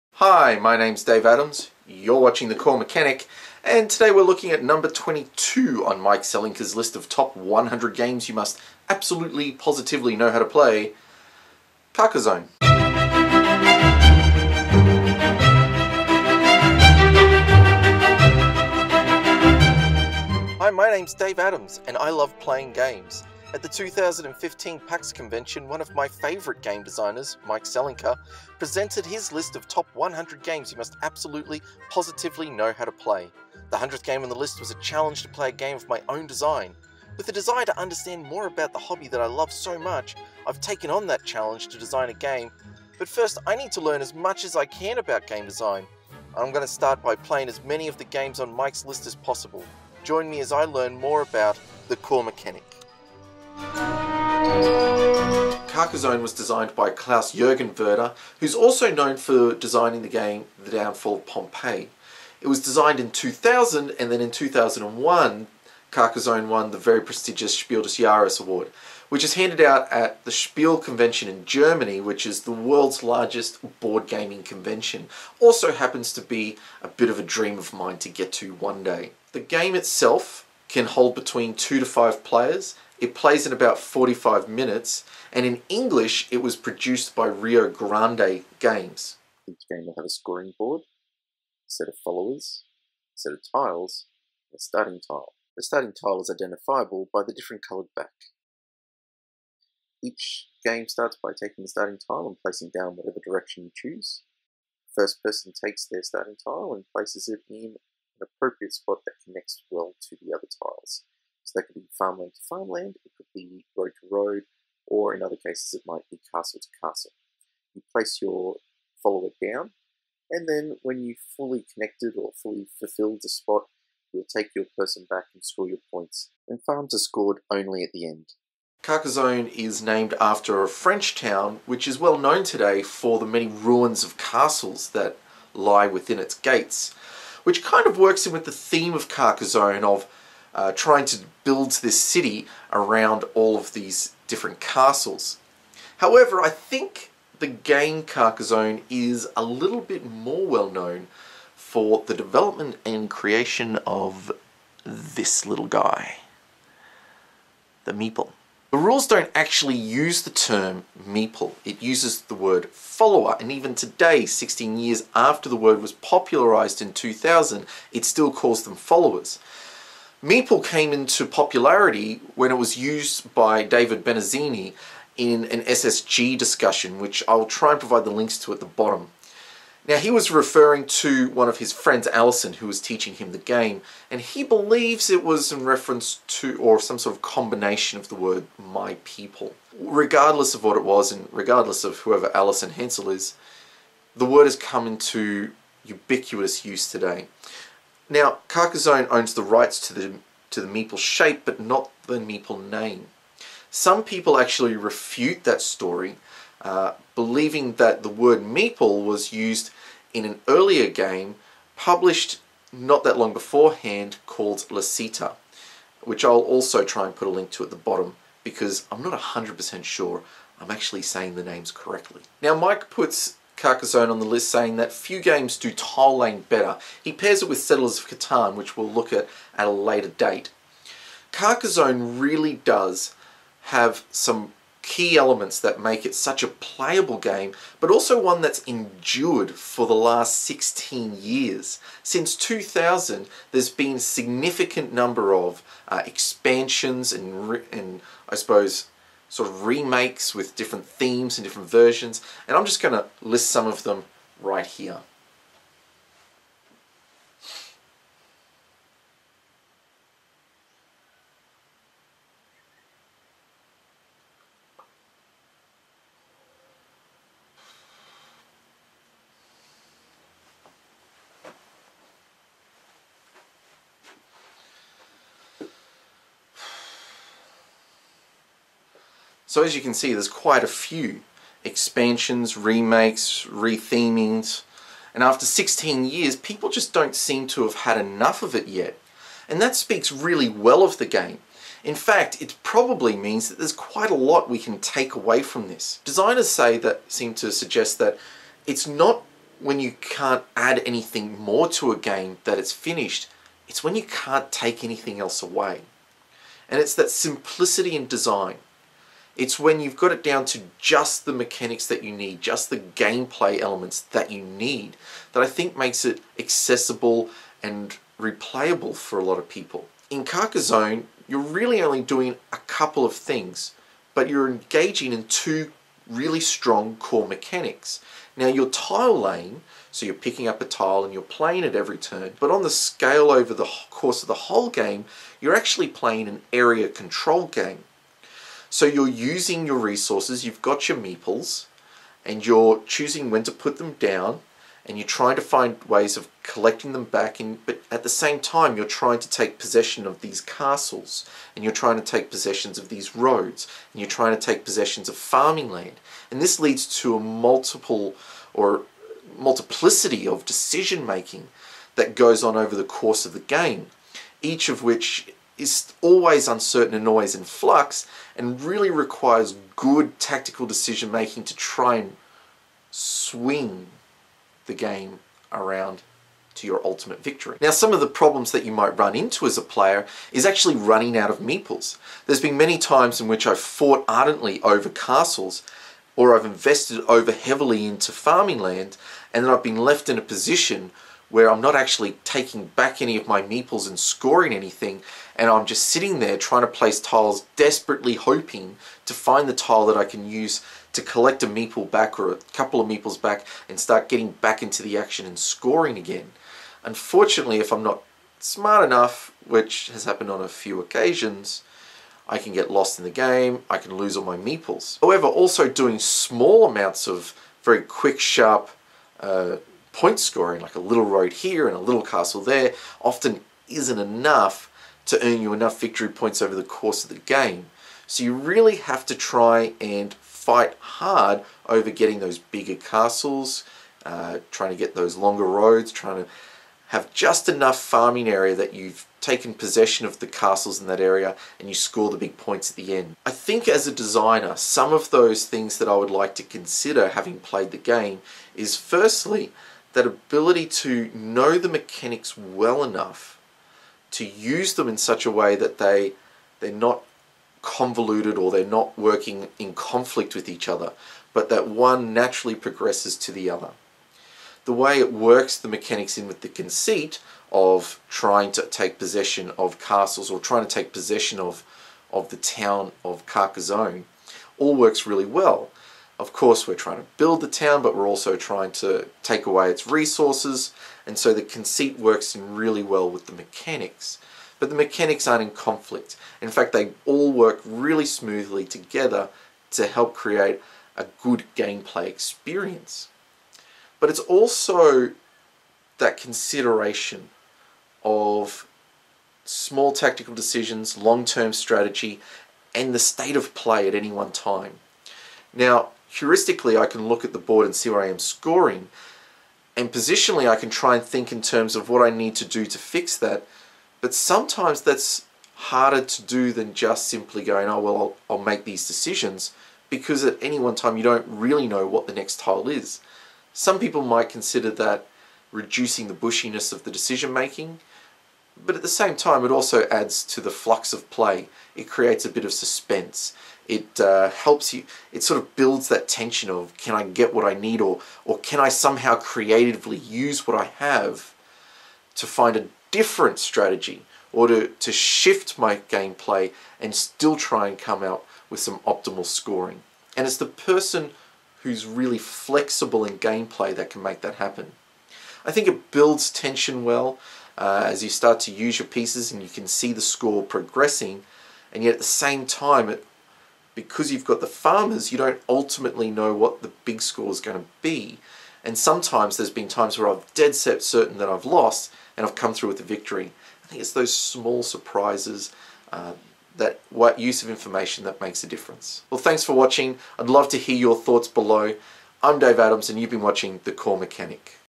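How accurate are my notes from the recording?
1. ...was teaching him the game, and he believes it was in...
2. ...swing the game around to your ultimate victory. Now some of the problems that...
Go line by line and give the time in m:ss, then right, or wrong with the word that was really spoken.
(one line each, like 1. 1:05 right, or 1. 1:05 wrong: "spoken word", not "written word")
1. 3:02 right
2. 6:12 right.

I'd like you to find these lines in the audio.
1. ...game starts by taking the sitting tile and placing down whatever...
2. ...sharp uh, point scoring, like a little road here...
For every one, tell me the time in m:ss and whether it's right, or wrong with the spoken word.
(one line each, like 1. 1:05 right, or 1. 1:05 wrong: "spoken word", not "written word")
1. 1:40 wrong: "starting", not "sitting"
2. 6:58 right.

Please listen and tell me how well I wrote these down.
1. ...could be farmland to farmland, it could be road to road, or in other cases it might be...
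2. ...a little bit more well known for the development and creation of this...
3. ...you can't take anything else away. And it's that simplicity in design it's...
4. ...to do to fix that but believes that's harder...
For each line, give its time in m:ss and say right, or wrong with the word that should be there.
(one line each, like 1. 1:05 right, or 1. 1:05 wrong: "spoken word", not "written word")
1. 1:51 right
2. 2:29 right
3. 5:03 right
4. 8:32 wrong: "sometimes", not "believes".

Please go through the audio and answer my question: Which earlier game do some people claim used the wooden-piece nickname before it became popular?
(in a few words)
Lasita.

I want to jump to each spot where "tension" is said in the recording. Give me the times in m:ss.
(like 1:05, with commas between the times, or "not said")
8:56, 9:16.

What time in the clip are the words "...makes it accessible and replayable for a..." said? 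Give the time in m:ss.
5:15.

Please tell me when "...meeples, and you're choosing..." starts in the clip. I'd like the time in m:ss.
5:40.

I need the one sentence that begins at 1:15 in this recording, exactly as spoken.
Also happens to be a bit of a dream of mine to get to one day.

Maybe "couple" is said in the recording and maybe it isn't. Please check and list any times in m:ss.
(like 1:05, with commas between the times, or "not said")
5:22, 6:42.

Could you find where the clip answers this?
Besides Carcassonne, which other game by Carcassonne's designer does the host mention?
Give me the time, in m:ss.
1:00.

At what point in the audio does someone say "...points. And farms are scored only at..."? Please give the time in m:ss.
2:05.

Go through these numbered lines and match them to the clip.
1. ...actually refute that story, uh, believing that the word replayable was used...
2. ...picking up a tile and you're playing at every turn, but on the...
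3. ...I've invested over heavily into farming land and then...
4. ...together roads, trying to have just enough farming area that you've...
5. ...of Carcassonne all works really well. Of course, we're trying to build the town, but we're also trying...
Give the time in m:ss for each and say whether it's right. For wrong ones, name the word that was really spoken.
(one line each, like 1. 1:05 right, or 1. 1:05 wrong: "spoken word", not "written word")
1. 3:24 wrong: "meeple", not "replayable"
2. 5:30 right
3. 6:26 right
4. 7:15 wrong: "longer", not "together"
5. 7:53 right.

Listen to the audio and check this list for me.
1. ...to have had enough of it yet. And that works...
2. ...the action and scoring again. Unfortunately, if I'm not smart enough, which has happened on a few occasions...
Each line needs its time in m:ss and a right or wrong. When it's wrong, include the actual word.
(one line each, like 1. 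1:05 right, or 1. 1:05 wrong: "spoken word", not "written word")
1. 4:47 wrong: "speaks", not "works"
2. 6:44 right.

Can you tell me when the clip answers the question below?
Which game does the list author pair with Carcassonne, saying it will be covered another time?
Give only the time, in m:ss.
3:47.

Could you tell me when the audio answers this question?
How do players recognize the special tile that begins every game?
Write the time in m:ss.
1:37.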